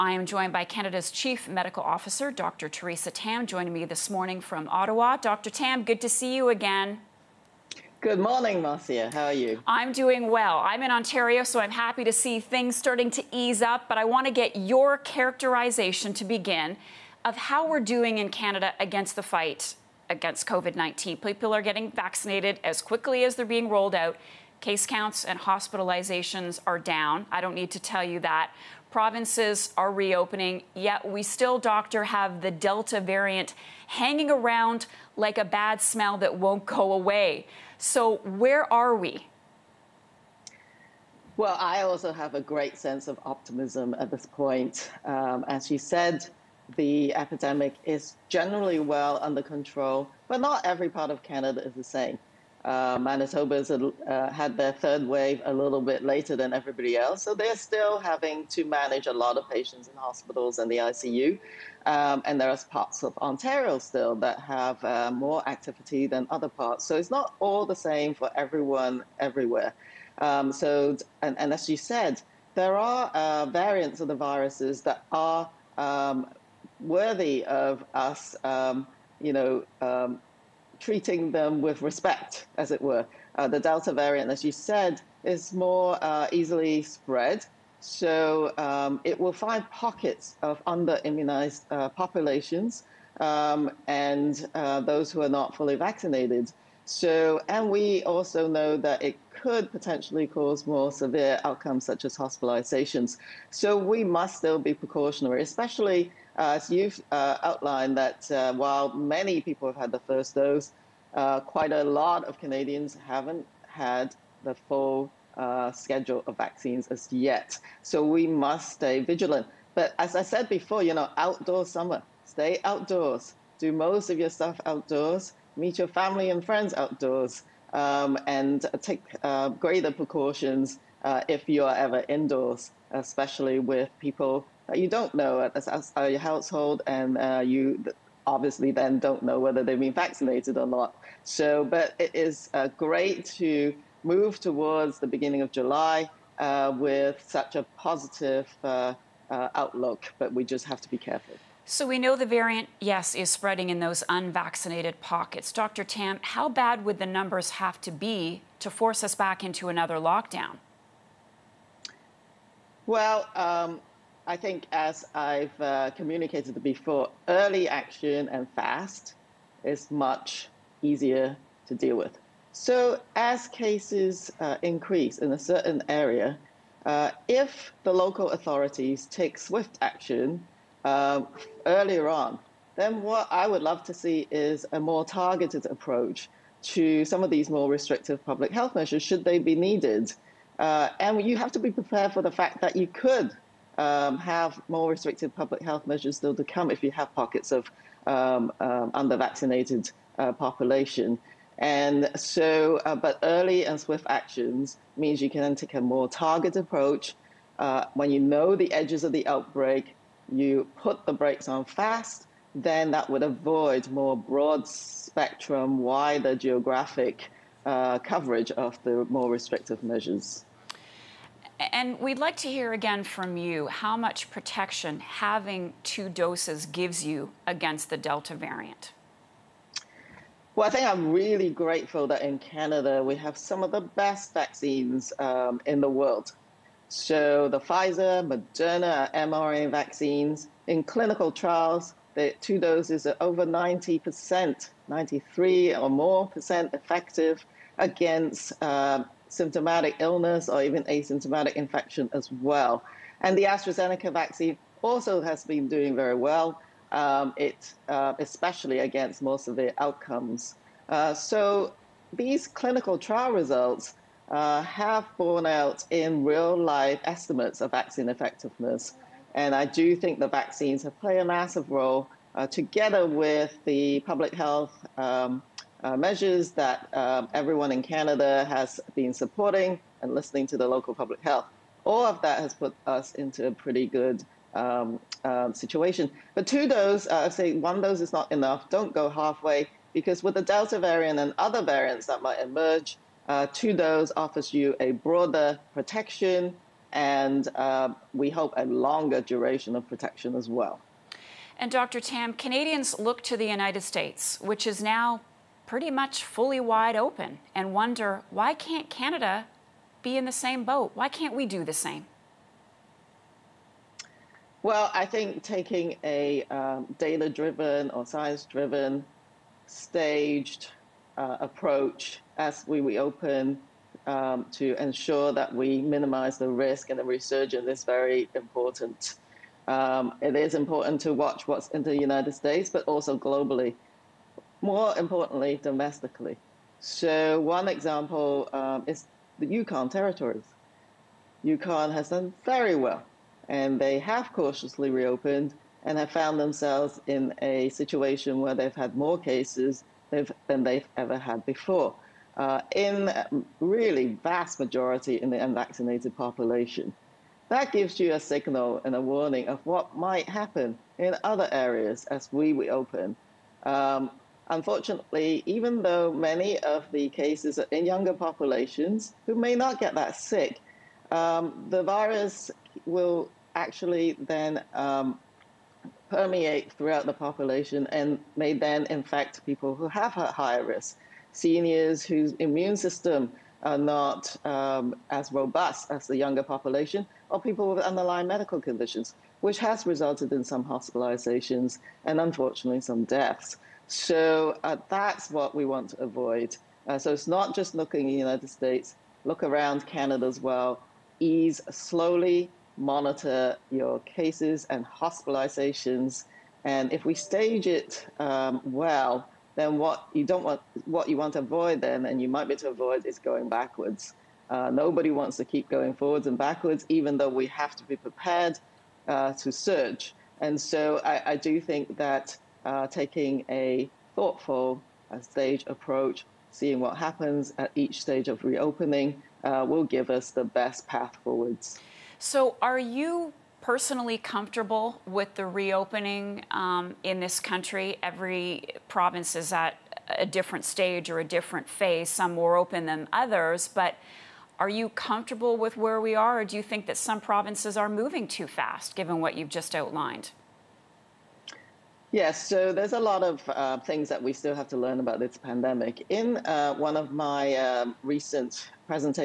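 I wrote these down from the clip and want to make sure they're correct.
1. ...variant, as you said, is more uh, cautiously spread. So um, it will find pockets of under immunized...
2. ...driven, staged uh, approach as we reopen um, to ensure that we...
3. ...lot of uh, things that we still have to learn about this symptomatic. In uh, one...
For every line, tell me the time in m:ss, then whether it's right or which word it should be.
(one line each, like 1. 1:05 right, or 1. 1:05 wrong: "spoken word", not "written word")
1. 1:23 wrong: "easily", not "cautiously"
2. 5:18 right
3. 7:32 wrong: "pandemic", not "symptomatic".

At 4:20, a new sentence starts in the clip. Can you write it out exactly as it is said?
Uh, so these clinical trial results uh, have borne out in real life estimates of vaccine effectiveness.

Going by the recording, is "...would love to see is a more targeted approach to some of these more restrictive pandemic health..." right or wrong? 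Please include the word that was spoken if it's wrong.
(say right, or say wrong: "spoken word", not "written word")
wrong: "public", not "pandemic".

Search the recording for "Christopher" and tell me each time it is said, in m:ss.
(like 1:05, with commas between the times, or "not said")
not said.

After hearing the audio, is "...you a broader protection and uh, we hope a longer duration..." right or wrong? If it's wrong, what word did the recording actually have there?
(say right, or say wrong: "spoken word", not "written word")
right.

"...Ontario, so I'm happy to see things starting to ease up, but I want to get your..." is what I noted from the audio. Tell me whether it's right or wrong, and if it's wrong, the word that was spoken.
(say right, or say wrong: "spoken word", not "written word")
right.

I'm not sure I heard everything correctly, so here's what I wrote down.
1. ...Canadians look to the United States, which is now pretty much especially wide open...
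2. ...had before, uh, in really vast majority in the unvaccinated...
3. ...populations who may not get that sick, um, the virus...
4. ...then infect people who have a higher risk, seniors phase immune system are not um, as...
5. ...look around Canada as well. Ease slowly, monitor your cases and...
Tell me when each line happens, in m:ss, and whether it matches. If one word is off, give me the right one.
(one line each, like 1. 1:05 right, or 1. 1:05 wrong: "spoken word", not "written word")
1. 5:02 wrong: "fully", not "especially"
2. 5:51 right
3. 6:08 right
4. 6:18 wrong: "whose", not "phase"
5. 6:39 right.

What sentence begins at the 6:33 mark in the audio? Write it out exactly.
So uh, that's what we want to avoid.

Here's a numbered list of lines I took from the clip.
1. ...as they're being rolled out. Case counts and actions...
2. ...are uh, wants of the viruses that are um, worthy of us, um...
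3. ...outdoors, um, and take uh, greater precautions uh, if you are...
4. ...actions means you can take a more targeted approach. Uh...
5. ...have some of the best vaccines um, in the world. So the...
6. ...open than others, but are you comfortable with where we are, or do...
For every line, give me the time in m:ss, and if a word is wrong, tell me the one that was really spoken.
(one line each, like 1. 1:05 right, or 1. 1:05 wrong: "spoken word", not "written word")
1. 0:23 wrong: "hospitalizations", not "actions"
2. 1:12 wrong: "variants", not "wants"
3. 2:06 right
4. 3:24 right
5. 3:53 right
6. 7:22 right.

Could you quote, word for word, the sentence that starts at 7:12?
So, are you personally comfortable with the reopening um, in this country?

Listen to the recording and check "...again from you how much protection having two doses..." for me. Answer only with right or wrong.
right.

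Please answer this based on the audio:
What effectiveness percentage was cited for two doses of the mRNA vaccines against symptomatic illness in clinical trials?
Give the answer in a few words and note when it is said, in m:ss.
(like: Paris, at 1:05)
93%, at 4:04.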